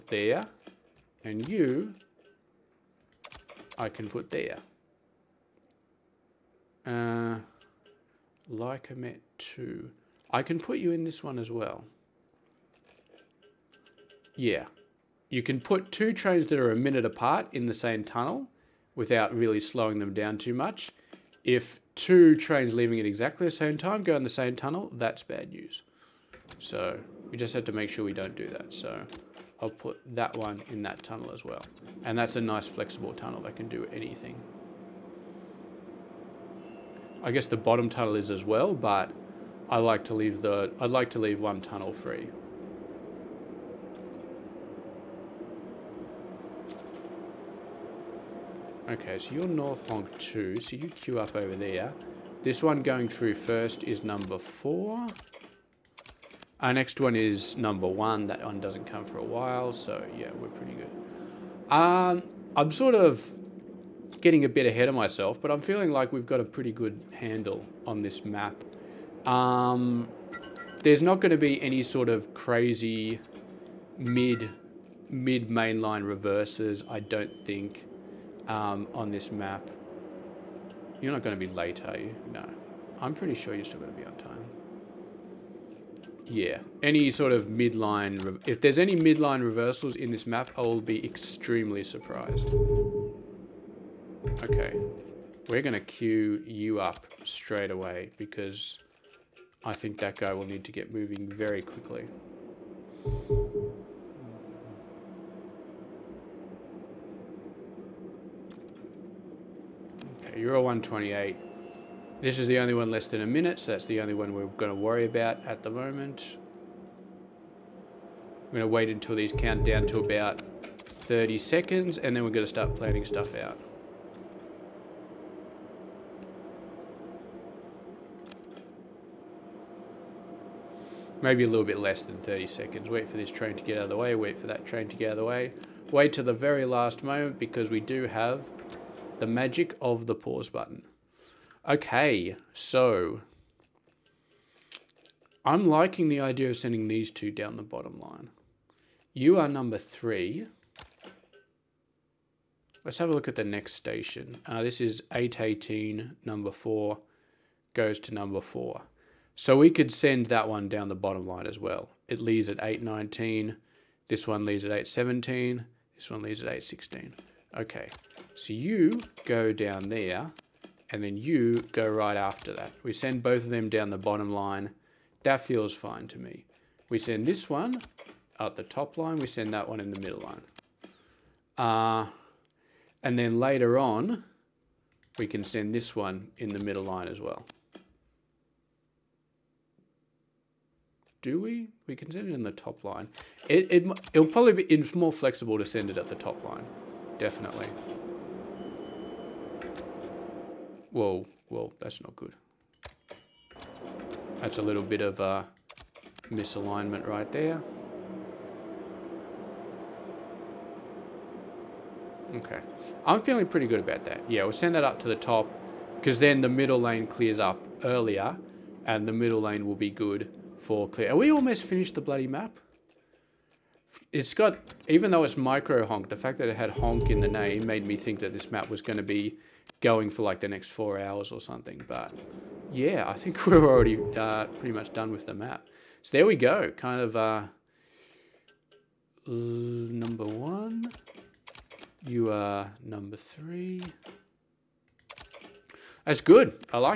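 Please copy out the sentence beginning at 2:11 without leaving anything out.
Maybe a little bit less than 30 seconds.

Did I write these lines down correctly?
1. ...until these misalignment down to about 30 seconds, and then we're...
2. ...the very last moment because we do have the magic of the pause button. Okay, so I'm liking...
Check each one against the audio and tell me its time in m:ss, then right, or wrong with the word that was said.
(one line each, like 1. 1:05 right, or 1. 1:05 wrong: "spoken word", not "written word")
1. 1:58 wrong: "count", not "misalignment"
2. 2:16 right.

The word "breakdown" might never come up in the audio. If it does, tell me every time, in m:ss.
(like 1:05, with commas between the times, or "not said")
not said.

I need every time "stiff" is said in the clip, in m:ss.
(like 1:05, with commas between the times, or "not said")
not said.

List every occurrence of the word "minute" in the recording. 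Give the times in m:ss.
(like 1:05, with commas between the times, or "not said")
0:16, 1:53.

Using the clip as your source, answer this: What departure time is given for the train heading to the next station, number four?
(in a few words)
8:18.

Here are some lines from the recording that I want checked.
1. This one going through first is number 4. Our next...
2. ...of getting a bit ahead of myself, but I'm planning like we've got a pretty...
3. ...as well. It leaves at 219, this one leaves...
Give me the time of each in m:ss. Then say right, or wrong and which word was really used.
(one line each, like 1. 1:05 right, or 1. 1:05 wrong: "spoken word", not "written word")
1. 0:52 right
2. 1:02 wrong: "feeling", not "planning"
3. 2:41 wrong: "819", not "219".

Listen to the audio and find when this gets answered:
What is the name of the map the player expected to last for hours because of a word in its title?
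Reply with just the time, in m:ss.
3:45.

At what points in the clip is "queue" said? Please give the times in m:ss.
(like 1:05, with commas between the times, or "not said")
0:50, 1:35.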